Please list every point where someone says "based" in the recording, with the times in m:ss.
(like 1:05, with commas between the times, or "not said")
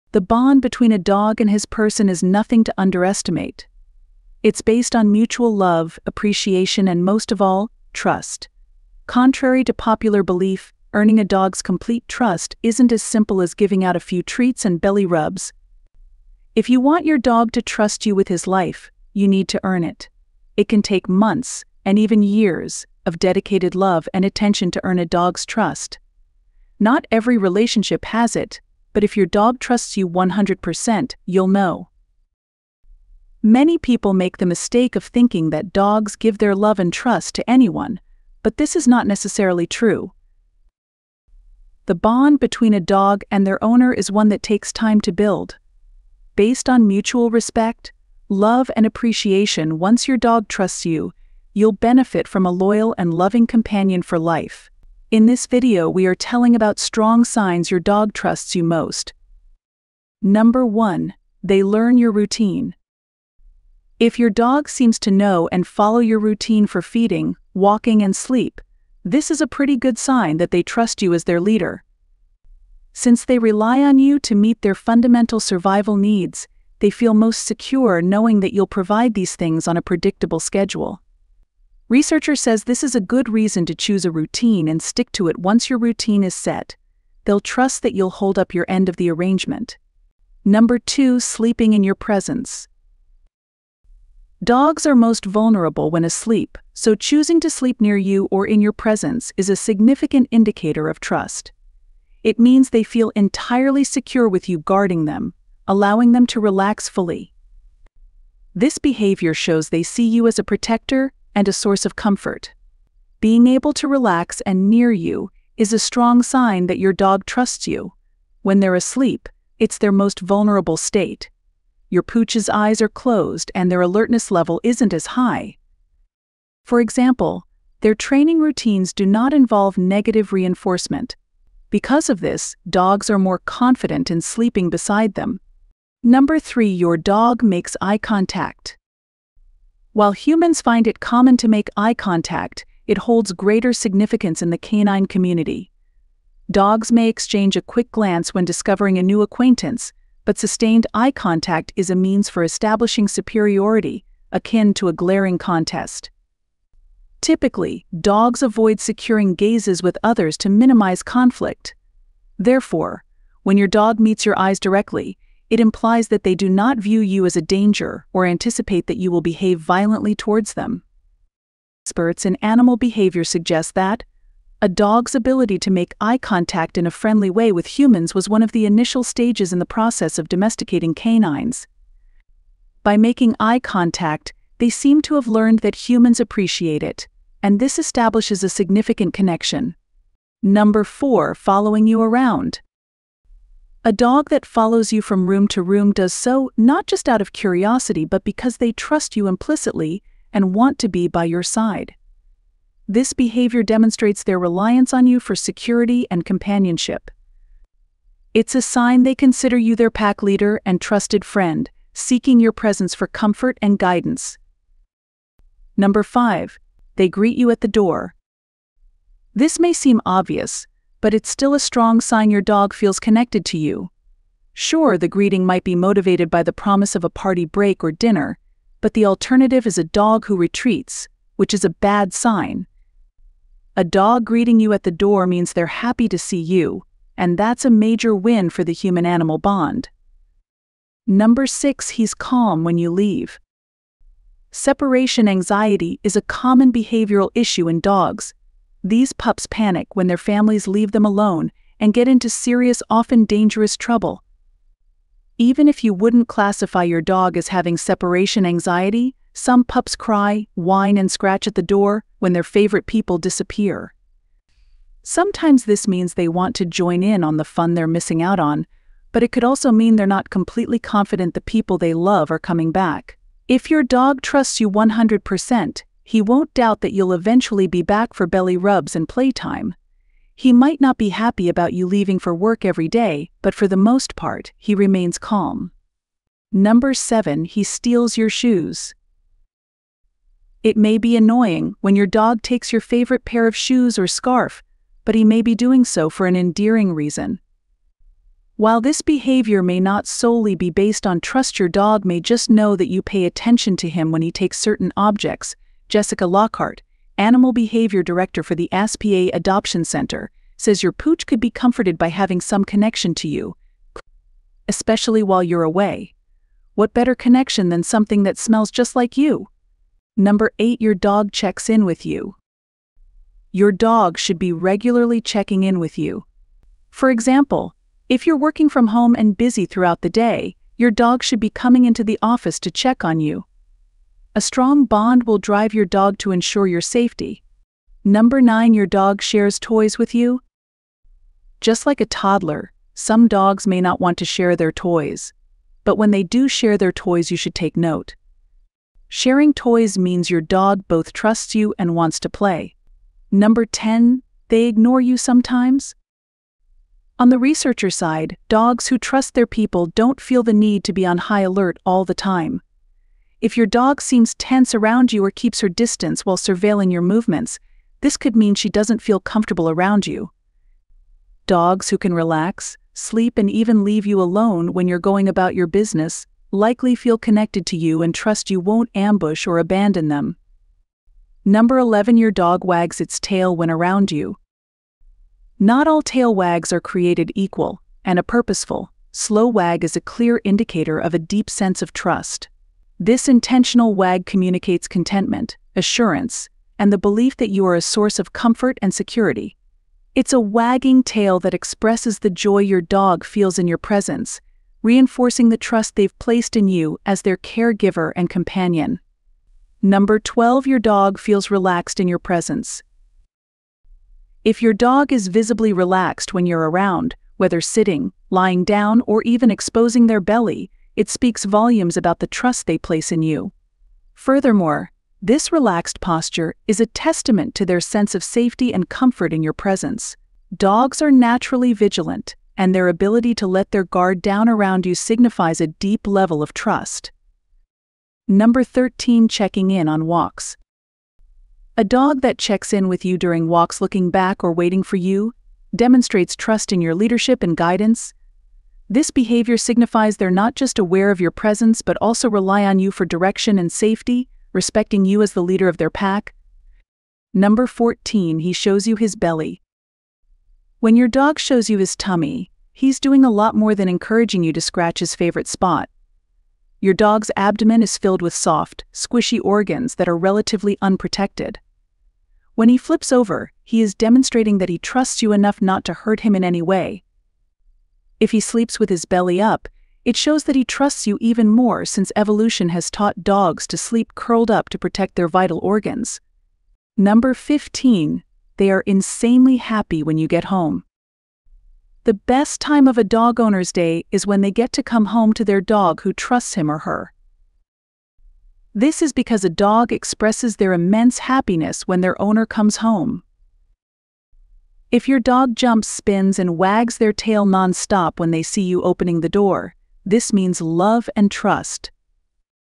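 0:04, 0:46, 5:00.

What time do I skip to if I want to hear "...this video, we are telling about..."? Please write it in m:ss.
0:55.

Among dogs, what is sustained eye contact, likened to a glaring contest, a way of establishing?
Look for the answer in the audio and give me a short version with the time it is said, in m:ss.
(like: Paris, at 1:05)
superiority, at 2:33.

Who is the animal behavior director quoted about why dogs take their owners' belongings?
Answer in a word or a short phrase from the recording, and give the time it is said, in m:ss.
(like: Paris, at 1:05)
Jessica Lockhart, at 5:05.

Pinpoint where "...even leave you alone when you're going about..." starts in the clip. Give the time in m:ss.
6:13.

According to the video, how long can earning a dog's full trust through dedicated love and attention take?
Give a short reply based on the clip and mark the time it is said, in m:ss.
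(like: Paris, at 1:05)
months, and even years, at 0:21.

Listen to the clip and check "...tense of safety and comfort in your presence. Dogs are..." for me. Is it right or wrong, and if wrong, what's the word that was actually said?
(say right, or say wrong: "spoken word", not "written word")
wrong: "sense", not "tense".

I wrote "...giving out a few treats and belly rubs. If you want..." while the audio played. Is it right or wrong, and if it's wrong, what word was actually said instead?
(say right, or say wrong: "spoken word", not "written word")
right.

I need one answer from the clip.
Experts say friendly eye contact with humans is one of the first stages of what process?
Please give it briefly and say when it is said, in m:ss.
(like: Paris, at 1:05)
domesticating canines, at 3:00.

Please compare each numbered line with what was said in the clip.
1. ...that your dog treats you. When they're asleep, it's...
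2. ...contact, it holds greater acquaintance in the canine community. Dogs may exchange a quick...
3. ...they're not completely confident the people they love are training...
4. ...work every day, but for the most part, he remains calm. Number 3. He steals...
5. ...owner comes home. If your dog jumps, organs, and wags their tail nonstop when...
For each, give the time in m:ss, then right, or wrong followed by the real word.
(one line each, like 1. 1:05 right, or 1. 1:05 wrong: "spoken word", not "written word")
1. 1:56 wrong: "trusts", not "treats"
2. 2:21 wrong: "significance", not "acquaintance"
3. 4:29 wrong: "coming", not "training"
4. 4:42 wrong: "7", not "3"
5. 8:22 wrong: "spins", not "organs".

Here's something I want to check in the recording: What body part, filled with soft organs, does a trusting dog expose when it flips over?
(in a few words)
abdomen.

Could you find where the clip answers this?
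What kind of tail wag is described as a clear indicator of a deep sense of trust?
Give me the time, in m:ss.
6:28.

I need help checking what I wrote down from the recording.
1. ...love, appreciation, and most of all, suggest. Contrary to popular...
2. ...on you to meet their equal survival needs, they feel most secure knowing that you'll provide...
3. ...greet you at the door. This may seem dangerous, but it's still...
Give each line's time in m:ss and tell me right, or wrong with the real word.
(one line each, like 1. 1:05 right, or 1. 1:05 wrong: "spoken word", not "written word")
1. 0:05 wrong: "trust", not "suggest"
2. 1:13 wrong: "fundamental", not "equal"
3. 3:37 wrong: "obvious", not "dangerous".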